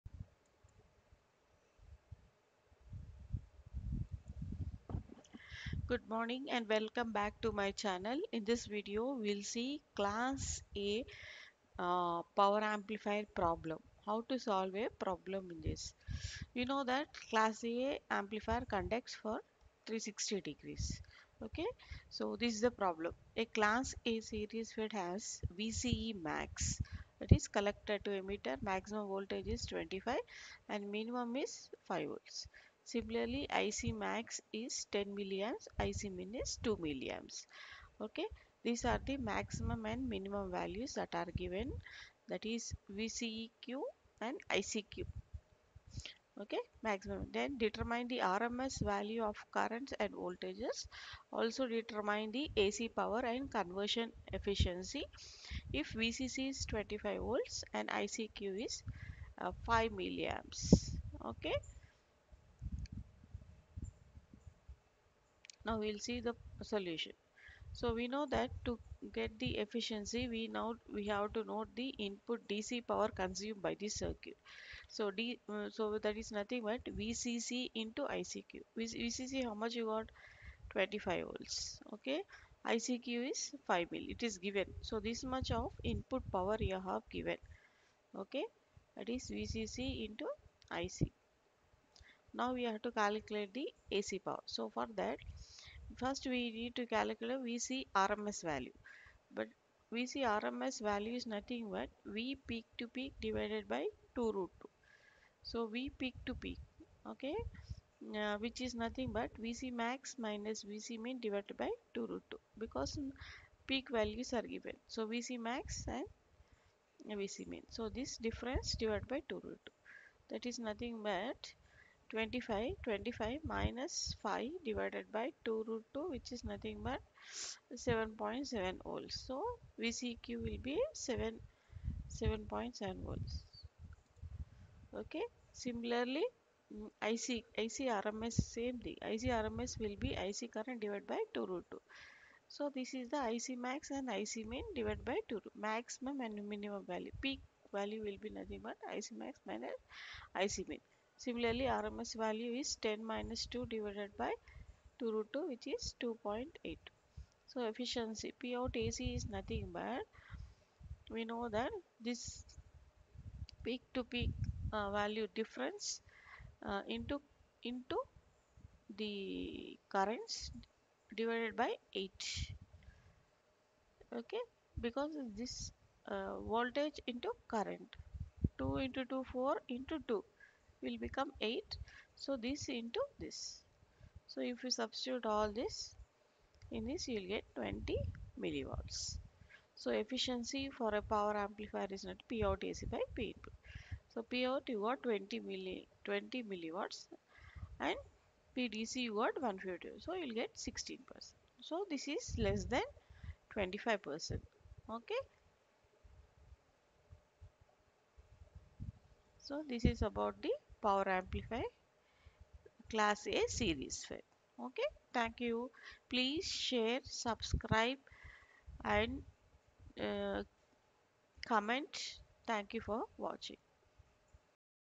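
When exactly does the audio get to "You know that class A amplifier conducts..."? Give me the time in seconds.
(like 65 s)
16 s.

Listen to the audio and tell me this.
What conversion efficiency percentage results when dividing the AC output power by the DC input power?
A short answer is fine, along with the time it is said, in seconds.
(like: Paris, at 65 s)
16 percent, at 200 s.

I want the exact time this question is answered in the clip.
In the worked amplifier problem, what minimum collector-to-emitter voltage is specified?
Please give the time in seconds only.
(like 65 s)
30 s.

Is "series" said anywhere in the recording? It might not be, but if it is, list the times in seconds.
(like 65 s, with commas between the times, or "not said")
24 s, 213 s.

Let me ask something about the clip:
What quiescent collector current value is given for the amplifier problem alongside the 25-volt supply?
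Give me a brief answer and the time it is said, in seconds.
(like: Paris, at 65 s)
5 milliamps, at 59 s.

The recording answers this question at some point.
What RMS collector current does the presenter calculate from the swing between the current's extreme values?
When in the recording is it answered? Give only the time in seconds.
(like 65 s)
156 s.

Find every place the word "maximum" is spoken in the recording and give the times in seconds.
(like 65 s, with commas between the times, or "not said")
28 s, 39 s, 46 s, 145 s.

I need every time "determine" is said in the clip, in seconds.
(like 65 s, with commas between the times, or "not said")
47 s, 51 s.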